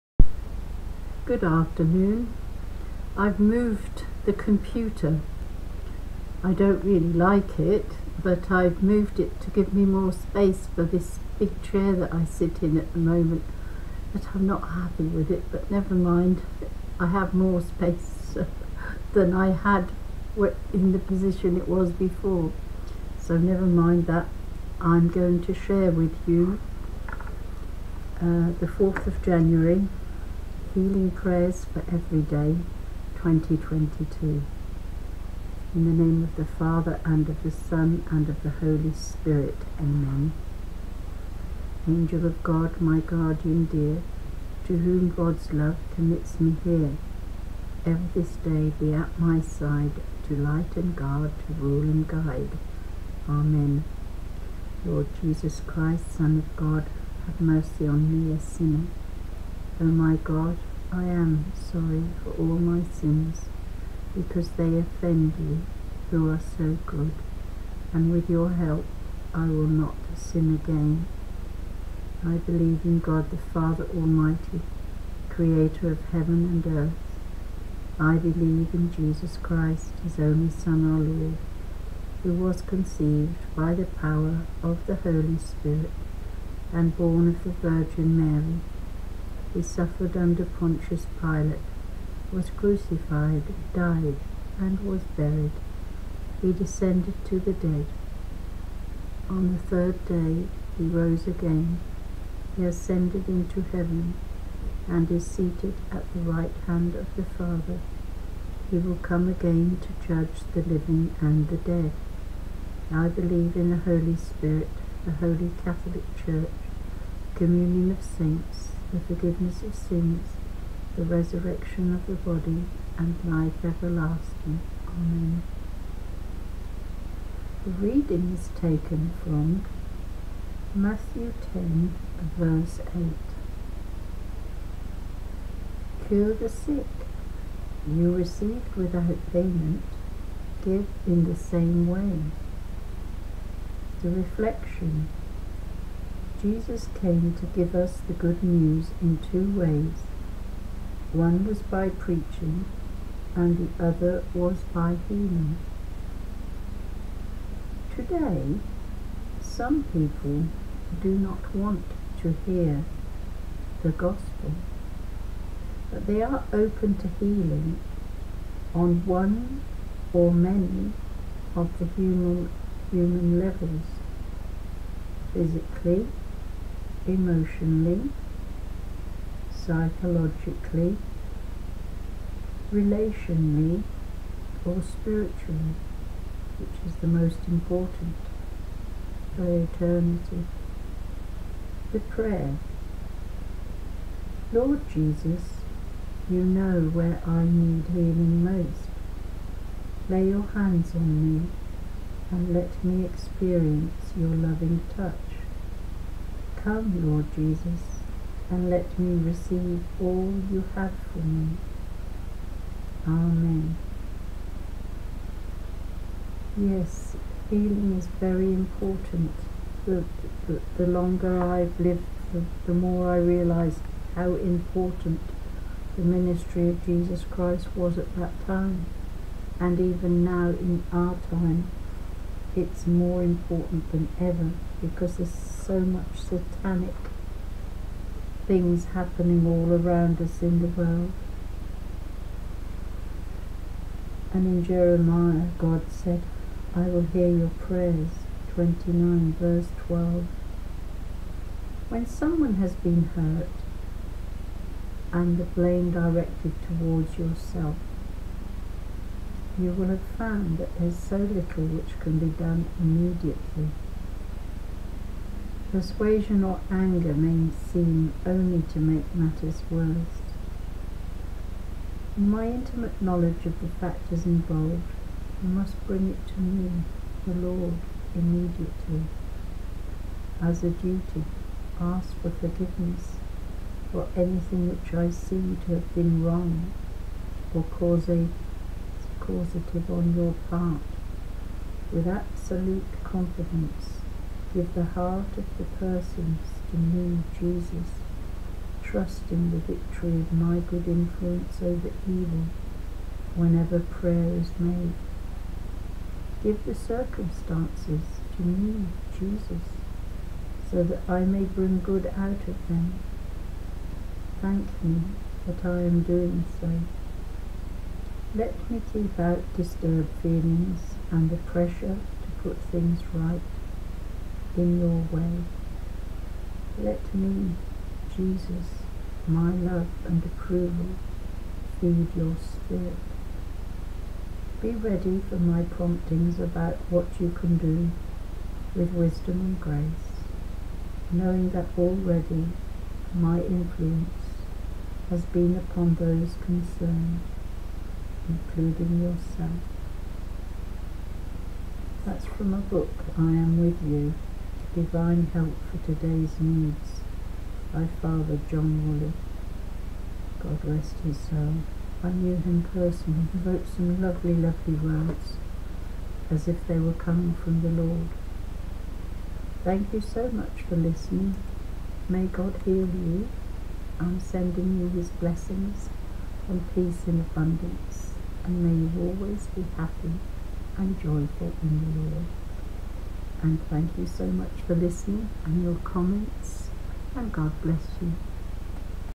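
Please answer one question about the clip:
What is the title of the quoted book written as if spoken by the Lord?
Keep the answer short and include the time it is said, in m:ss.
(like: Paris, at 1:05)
I Am With You, at 5:53.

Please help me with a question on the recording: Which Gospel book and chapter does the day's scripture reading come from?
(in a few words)
Matthew 10.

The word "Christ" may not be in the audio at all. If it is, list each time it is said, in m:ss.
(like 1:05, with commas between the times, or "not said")
0:55, 1:19, 3:47.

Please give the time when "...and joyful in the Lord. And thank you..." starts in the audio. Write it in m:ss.
6:20.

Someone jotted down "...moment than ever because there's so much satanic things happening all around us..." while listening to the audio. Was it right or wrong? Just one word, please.
wrong.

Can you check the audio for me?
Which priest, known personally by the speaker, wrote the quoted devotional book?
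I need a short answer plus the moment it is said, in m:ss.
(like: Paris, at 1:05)
Father John Woolley, at 5:58.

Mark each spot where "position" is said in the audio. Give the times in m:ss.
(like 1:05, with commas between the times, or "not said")
0:20.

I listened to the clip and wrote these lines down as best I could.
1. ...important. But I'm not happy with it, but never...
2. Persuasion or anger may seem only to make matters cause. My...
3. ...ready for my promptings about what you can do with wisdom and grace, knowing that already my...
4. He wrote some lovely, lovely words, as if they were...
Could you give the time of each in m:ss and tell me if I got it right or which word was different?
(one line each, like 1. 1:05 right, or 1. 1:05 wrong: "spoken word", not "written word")
1. 0:12 wrong: "moment", not "important"
2. 4:25 wrong: "worse", not "cause"
3. 5:34 right
4. 6:03 right.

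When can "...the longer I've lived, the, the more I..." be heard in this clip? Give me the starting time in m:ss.
3:40.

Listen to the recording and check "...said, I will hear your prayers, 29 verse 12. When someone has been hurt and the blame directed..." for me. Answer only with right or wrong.
right.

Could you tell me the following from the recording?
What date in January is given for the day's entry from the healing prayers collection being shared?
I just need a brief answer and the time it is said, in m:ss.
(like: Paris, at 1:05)
4th of January, at 0:28.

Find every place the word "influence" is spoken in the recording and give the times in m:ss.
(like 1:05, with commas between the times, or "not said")
5:00, 5:43.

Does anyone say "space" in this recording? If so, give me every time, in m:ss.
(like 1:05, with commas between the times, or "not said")
0:10, 0:17.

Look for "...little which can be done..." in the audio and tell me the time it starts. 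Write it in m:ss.
4:21.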